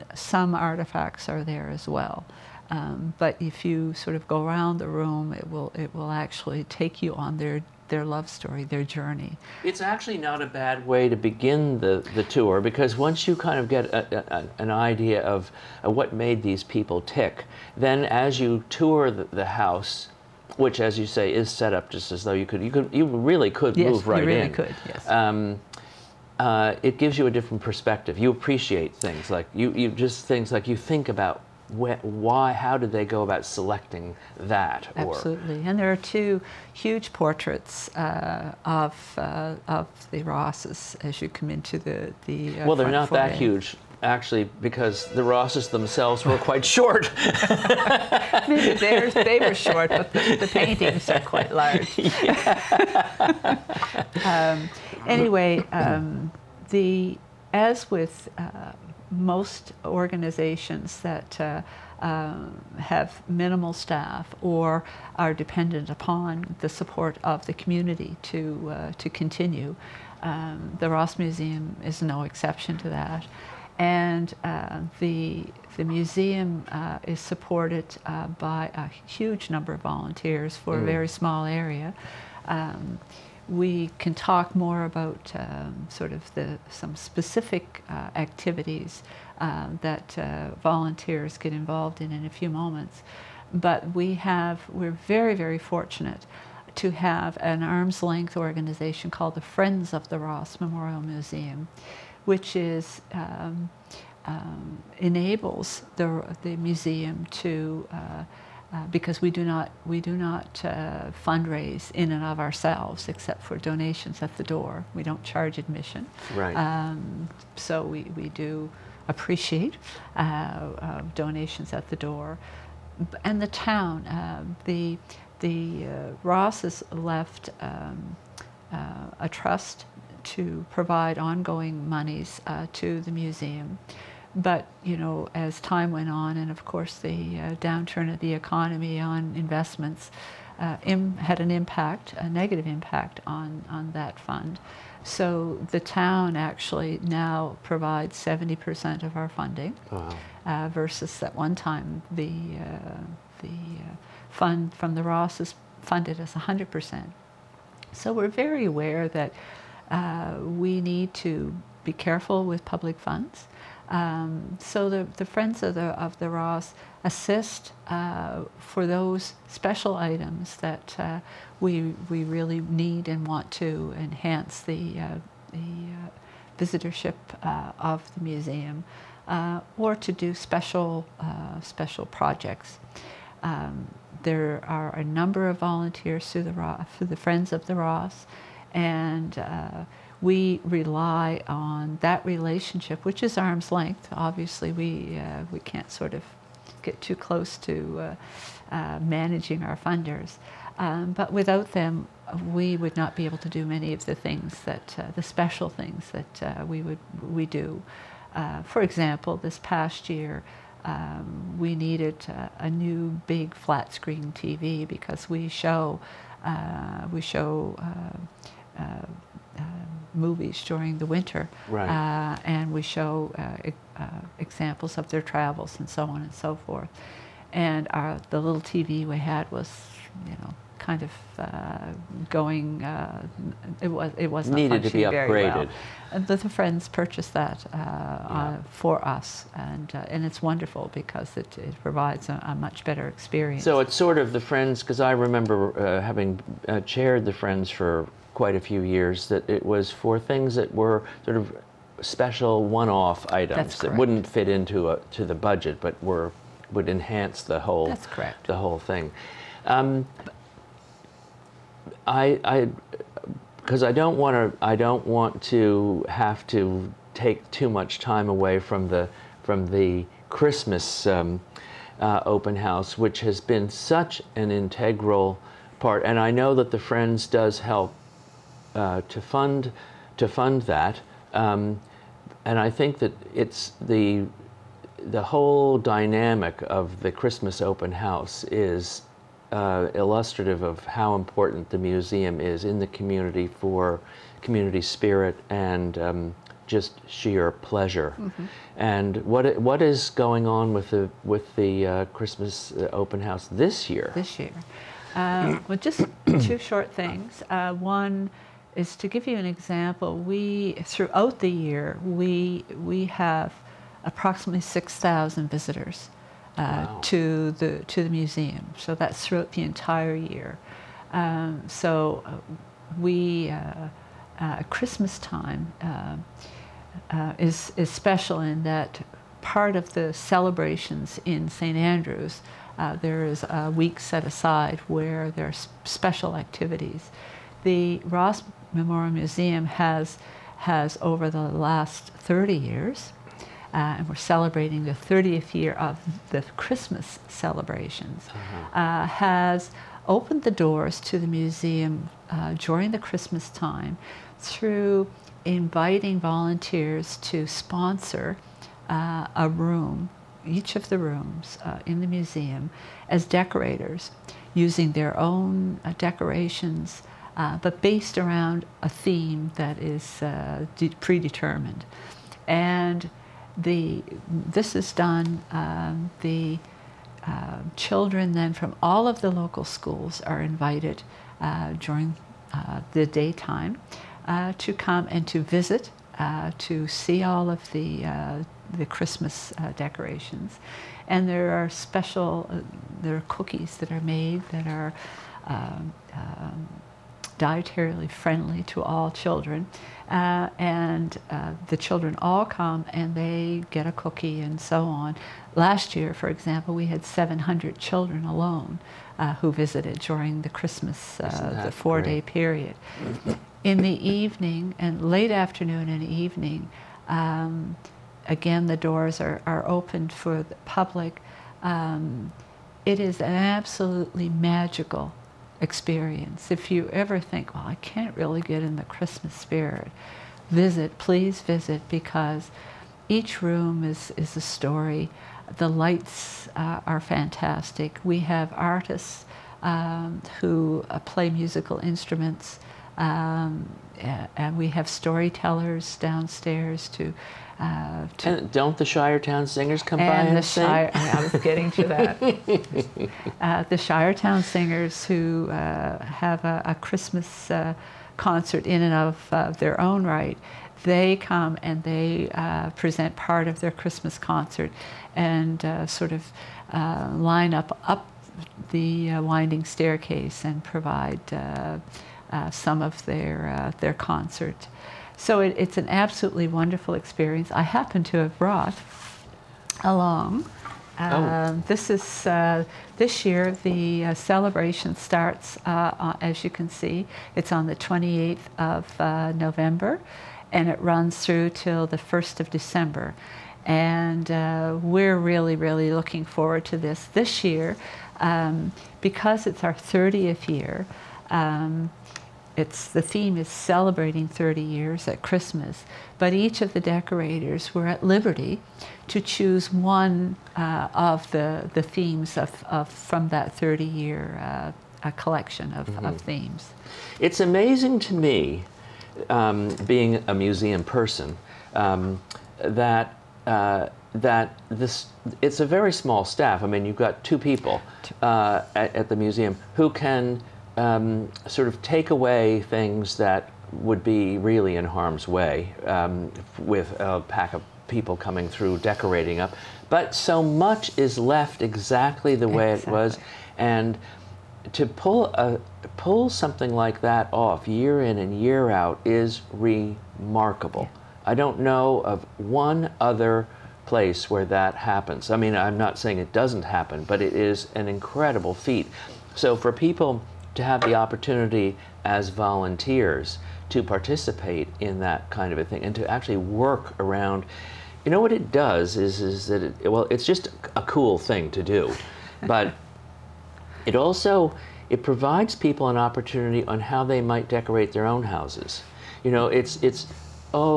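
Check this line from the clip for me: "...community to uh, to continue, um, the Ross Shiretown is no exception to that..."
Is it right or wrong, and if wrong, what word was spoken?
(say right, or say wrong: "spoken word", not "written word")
wrong: "Museum", not "Shiretown".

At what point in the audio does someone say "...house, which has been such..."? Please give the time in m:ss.
4:32.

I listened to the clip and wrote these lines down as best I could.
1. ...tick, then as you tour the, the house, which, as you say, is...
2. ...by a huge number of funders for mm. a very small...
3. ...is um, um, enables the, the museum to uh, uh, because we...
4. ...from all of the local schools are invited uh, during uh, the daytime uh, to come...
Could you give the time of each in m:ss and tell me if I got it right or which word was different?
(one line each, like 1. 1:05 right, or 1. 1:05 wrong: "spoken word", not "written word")
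1. 0:17 right
2. 1:18 wrong: "volunteers", not "funders"
3. 1:42 right
4. 6:18 right.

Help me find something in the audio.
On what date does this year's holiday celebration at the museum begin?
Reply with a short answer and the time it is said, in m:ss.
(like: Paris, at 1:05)
28th of November, at 8:07.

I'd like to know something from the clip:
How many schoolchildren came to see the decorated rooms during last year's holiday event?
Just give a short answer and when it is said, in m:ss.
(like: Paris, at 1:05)
700, at 6:47.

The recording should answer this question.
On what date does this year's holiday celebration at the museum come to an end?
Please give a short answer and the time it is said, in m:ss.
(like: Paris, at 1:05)
1st of December, at 8:11.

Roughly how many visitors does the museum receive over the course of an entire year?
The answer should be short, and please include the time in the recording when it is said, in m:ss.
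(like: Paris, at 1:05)
6000, at 5:14.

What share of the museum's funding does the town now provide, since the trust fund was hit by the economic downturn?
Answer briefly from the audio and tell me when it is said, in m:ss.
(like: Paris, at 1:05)
70%, at 2:28.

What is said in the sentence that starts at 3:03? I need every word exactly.
Um, there are a number of volunteers through the, through the Friends of the Ross.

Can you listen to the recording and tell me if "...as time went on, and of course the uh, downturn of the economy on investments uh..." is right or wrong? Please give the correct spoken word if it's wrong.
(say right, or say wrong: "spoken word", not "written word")
right.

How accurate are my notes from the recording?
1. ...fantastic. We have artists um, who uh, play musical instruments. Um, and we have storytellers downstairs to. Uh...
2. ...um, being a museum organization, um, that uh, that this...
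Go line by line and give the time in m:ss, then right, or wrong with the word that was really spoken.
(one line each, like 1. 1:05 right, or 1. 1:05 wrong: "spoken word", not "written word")
1. 7:17 right
2. 8:39 wrong: "person", not "organization".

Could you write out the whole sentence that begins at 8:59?
But so much is left exactly the way exactly.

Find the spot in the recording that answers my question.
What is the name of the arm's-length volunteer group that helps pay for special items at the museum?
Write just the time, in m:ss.
1:39.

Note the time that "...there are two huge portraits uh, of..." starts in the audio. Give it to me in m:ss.
0:35.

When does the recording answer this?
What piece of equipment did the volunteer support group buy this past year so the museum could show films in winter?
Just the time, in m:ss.
3:33.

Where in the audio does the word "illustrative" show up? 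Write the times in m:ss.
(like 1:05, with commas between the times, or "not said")
4:49.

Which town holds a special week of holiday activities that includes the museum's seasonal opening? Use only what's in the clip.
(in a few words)
St Andrews.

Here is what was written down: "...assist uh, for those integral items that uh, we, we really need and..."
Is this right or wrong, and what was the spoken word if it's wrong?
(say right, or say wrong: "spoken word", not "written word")
wrong: "special", not "integral".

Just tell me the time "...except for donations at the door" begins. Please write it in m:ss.
1:53.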